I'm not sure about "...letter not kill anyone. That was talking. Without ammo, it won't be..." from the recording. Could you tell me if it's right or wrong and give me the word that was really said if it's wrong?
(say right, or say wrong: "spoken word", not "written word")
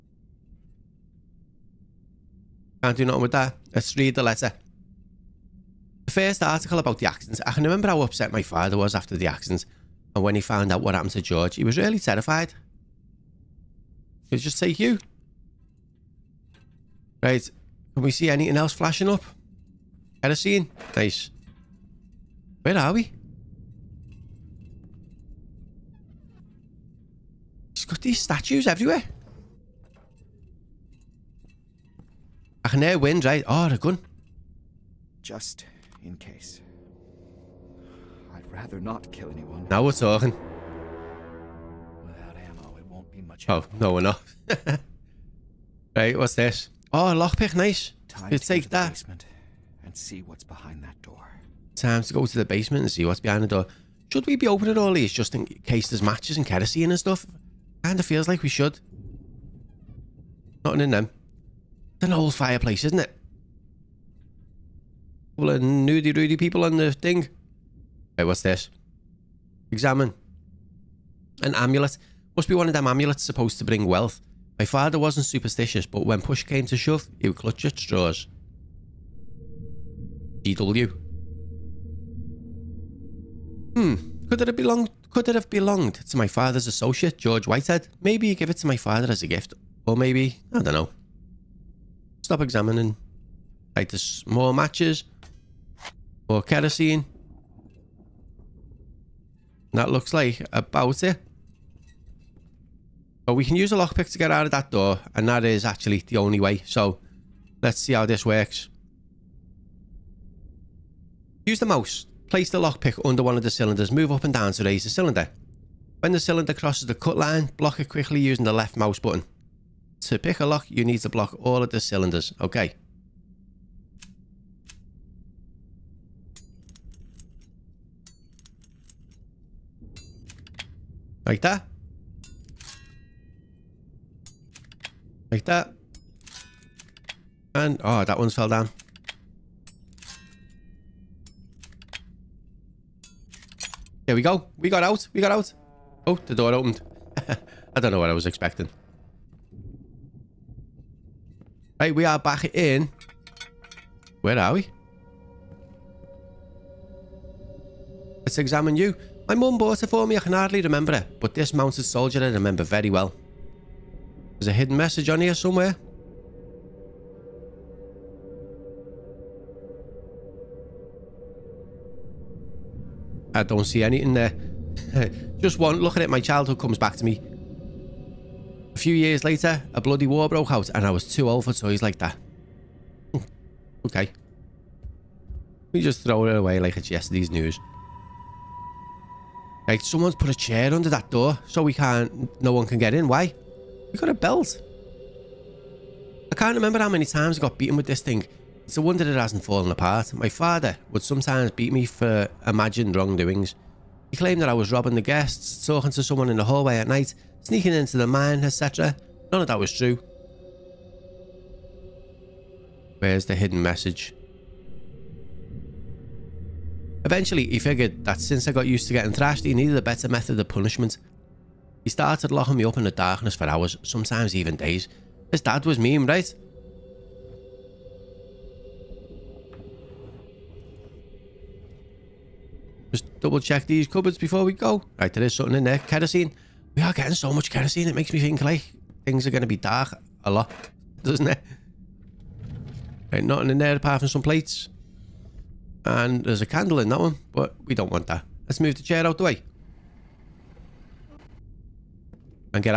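wrong: "rather", not "letter".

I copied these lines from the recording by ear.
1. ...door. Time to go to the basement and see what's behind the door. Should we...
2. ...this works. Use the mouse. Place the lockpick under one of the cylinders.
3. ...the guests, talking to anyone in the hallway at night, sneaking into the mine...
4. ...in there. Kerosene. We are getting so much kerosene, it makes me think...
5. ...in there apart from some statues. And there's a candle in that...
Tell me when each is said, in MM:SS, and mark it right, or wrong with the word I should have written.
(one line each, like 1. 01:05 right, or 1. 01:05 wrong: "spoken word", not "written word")
1. 00:51 right
2. 01:48 right
3. 03:24 wrong: "someone", not "anyone"
4. 03:55 right
5. 04:03 wrong: "plates", not "statues".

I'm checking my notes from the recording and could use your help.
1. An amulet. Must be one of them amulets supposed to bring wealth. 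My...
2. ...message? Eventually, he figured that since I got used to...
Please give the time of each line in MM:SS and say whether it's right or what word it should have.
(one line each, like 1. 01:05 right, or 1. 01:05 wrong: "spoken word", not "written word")
1. 01:11 right
2. 03:33 right.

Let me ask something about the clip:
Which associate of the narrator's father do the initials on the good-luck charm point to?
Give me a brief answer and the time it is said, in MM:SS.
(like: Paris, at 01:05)
George Whitehead, at 01:27.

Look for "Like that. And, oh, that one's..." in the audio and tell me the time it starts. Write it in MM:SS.
02:15.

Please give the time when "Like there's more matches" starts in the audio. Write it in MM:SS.
01:33.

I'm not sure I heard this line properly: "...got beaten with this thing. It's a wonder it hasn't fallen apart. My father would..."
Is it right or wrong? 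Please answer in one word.
right.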